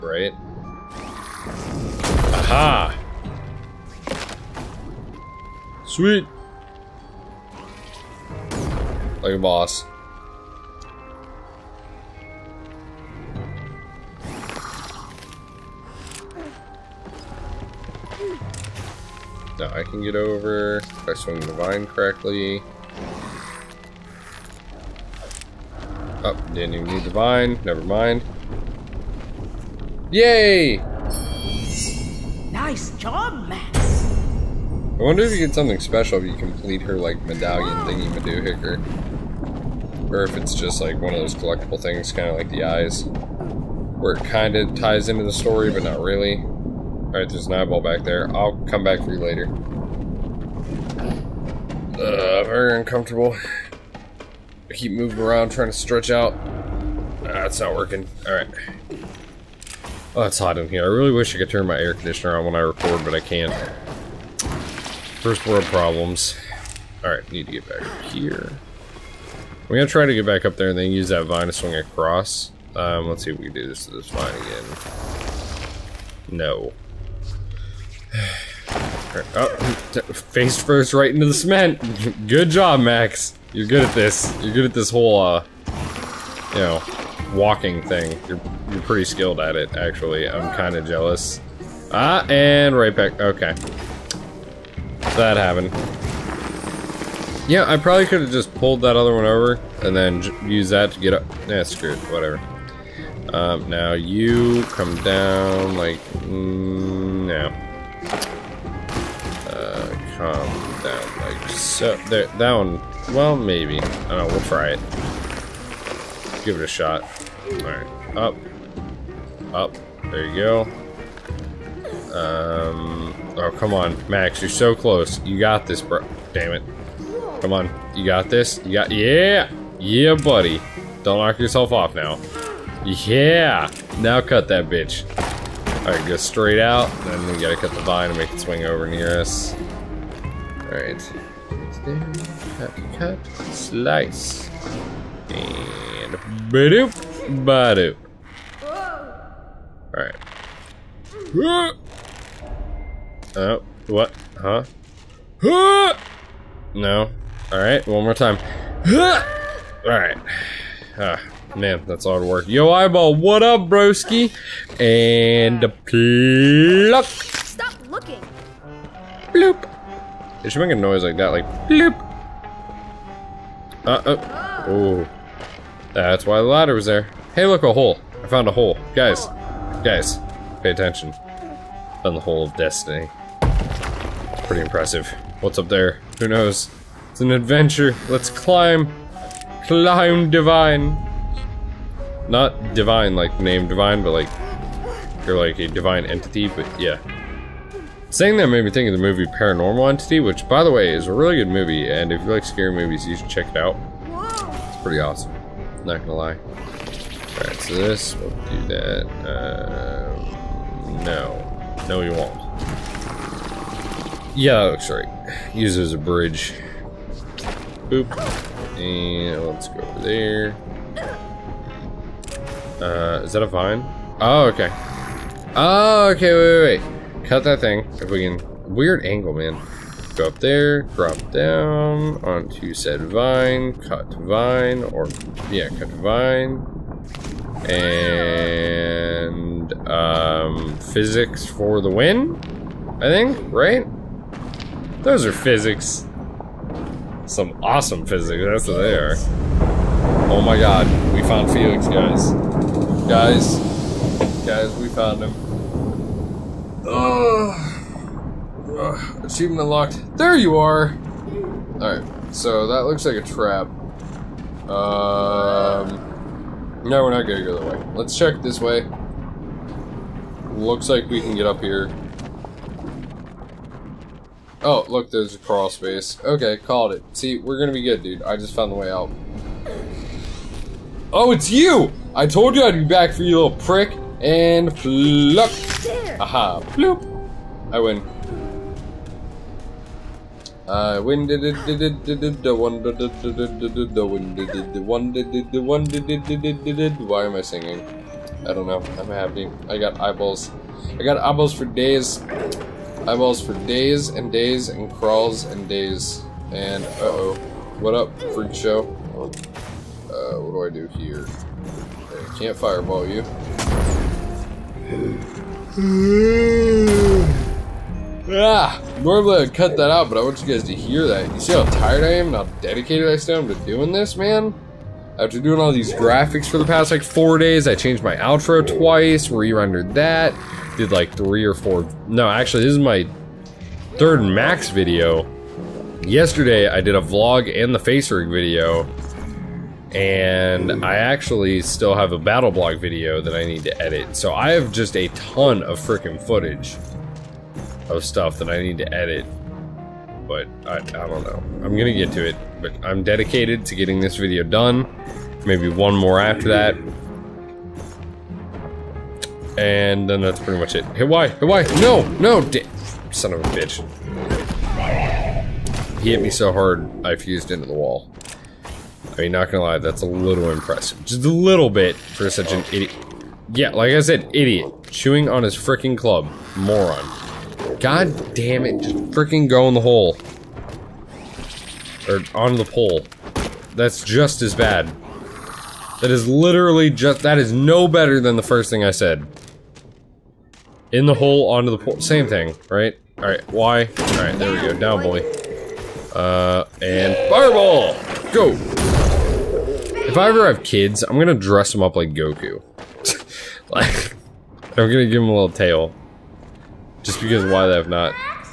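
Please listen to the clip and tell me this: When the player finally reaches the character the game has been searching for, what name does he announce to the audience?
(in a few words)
Felix.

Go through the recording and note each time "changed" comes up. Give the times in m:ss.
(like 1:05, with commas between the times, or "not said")
5:27.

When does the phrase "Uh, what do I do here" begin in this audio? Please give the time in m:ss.
5:10.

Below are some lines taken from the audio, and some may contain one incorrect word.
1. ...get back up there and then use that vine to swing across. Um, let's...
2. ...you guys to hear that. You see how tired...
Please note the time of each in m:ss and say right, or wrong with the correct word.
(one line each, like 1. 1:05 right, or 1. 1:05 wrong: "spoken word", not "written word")
1. 1:10 right
2. 5:20 right.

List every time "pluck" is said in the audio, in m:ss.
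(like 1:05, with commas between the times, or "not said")
2:45, 4:44.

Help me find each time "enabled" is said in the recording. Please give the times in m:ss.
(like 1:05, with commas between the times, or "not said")
not said.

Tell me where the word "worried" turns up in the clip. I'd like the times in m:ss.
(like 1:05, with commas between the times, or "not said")
not said.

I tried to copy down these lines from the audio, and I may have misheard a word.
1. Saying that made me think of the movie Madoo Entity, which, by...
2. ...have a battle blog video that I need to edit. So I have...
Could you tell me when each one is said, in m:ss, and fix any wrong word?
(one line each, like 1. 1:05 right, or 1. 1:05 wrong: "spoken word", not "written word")
1. 3:18 wrong: "Paranormal", not "Madoo"
2. 5:41 right.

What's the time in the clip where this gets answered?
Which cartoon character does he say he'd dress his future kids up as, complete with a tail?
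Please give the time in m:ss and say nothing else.
6:42.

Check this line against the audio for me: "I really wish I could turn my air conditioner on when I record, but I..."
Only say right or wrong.
right.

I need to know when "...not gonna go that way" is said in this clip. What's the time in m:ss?
4:27.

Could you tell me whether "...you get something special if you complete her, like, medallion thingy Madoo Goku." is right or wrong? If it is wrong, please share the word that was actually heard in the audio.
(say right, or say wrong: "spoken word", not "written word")
wrong: "Hicker", not "Goku".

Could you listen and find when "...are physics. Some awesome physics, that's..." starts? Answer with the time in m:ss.
4:05.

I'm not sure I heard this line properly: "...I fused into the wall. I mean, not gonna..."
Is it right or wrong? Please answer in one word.
right.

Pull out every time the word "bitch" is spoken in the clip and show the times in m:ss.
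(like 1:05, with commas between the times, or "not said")
2:14, 6:03.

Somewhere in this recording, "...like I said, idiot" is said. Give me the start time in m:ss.
6:13.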